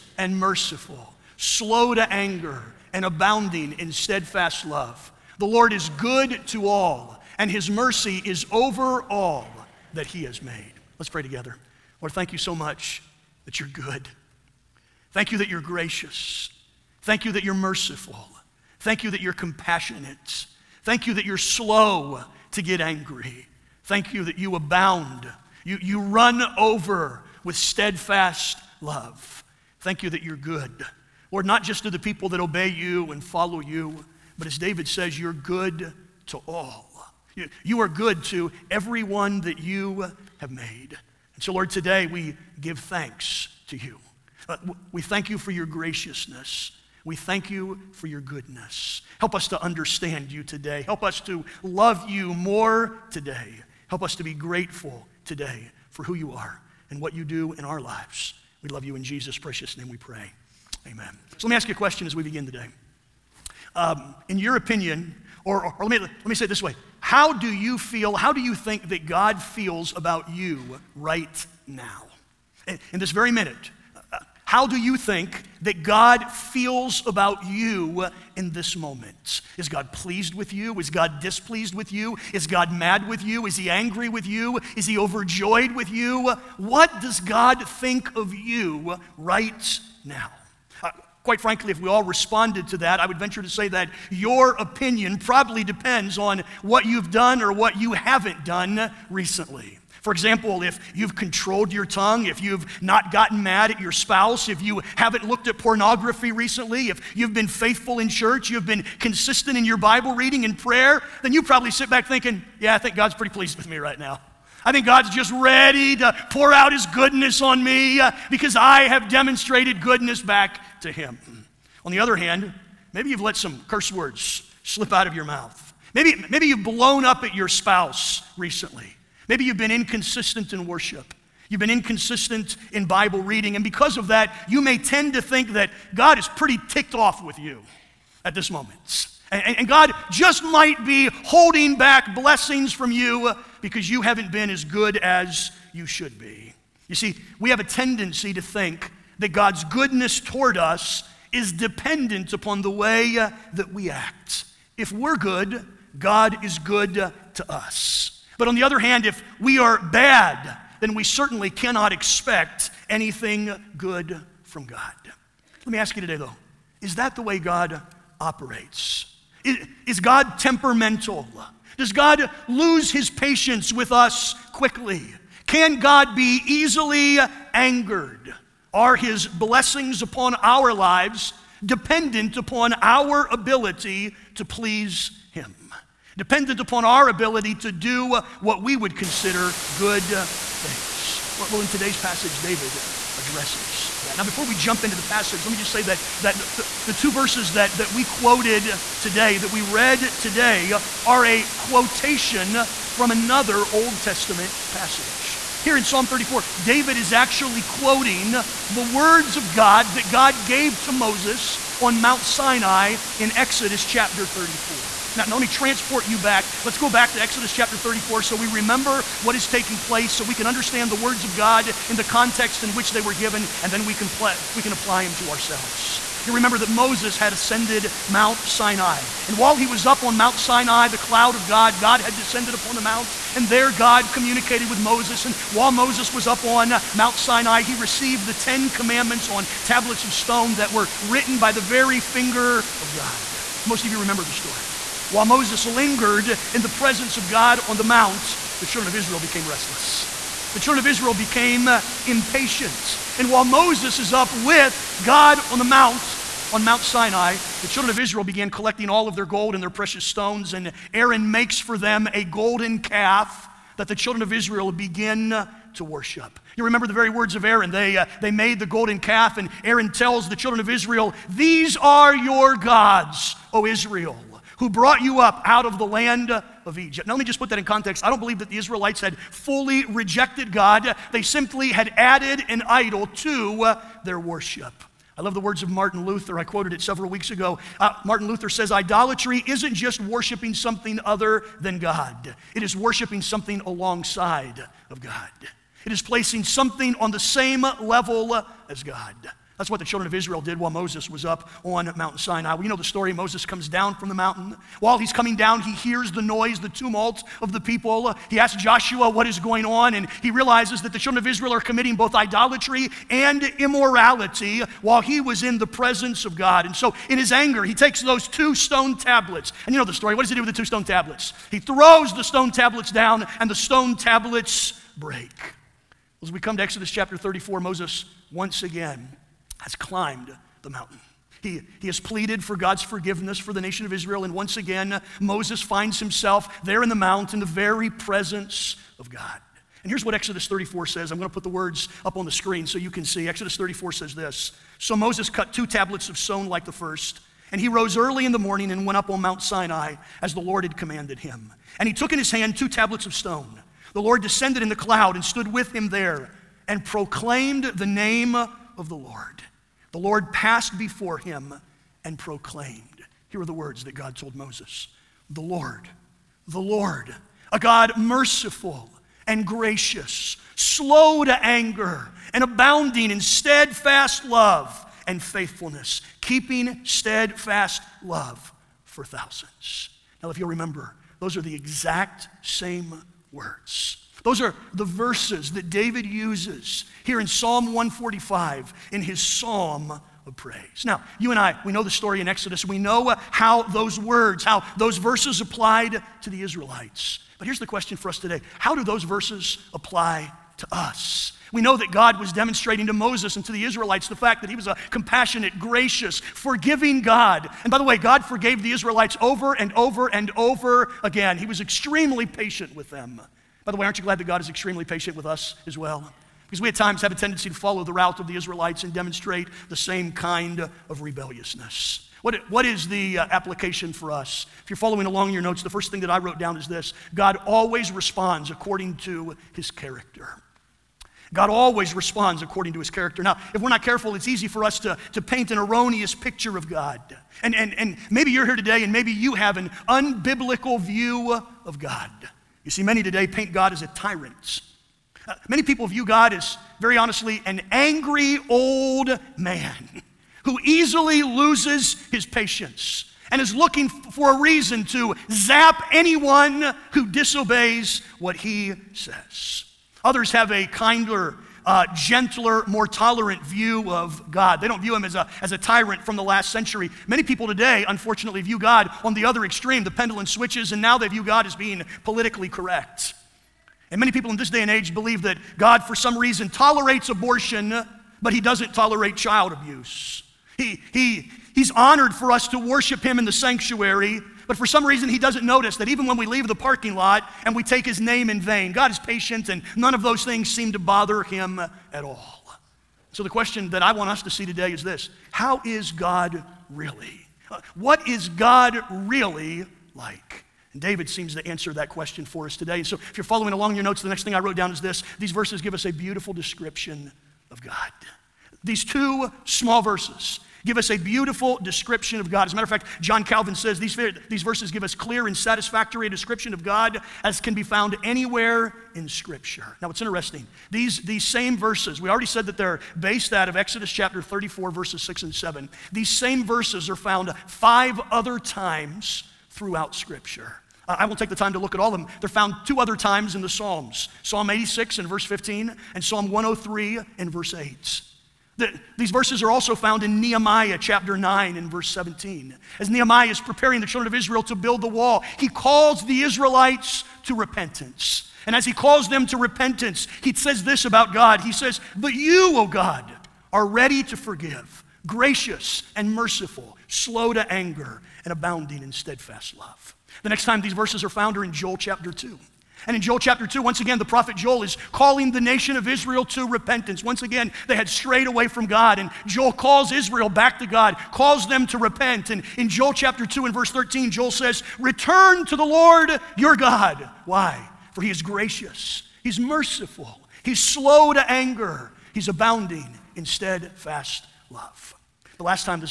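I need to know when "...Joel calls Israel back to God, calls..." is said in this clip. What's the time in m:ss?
9:29.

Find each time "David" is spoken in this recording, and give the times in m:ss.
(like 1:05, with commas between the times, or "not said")
0:34, 3:12, 3:26, 6:25, 8:20.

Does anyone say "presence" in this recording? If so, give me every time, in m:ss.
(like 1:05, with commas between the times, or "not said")
4:06, 5:15, 5:37.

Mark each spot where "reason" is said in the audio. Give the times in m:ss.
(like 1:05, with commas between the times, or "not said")
7:34, 7:56, 8:04.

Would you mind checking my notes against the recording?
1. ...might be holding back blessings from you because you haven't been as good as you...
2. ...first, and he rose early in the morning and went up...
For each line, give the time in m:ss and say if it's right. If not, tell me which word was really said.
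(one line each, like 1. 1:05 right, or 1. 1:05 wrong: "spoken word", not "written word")
1. 2:20 right
2. 5:46 right.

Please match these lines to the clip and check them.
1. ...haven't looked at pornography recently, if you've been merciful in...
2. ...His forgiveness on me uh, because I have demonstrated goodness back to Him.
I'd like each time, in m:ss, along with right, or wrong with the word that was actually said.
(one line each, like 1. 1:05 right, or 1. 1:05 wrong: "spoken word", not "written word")
1. 1:44 wrong: "faithful", not "merciful"
2. 1:56 wrong: "goodness", not "forgiveness".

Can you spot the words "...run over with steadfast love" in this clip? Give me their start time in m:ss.
0:25.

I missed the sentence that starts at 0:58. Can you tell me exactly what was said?
We love you in Jesus' precious name we pray.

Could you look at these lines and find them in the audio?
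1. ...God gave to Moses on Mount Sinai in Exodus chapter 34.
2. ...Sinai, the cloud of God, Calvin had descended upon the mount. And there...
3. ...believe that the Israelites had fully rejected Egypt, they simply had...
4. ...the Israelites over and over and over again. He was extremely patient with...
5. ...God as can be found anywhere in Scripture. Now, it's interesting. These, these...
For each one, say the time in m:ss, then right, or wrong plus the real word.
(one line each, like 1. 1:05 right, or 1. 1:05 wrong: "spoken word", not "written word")
1. 3:30 right
2. 3:50 wrong: "God", not "Calvin"
3. 4:38 wrong: "God", not "Egypt"
4. 6:48 right
5. 8:36 right.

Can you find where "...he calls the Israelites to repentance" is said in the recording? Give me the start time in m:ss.
9:05.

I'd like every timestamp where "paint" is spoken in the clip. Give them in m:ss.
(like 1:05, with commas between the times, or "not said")
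7:15, 7:23.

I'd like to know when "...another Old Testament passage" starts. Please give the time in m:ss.
3:23.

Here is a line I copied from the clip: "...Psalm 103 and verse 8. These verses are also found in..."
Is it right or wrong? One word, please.
right.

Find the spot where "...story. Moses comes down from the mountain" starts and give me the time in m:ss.
5:02.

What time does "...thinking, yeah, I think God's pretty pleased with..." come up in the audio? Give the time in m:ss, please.
1:52.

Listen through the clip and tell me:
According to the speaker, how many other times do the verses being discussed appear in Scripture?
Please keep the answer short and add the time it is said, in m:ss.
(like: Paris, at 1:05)
5, at 8:47.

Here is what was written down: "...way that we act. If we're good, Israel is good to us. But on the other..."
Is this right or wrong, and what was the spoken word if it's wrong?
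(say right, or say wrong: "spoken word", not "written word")
wrong: "God", not "Israel".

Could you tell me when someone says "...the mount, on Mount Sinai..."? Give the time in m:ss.
4:15.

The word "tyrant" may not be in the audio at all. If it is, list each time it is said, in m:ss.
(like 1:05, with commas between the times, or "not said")
7:23, 7:45.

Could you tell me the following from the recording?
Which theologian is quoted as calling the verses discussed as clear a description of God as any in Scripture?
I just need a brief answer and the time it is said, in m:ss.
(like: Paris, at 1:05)
John Calvin, at 8:32.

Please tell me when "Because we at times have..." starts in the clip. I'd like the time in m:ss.
6:56.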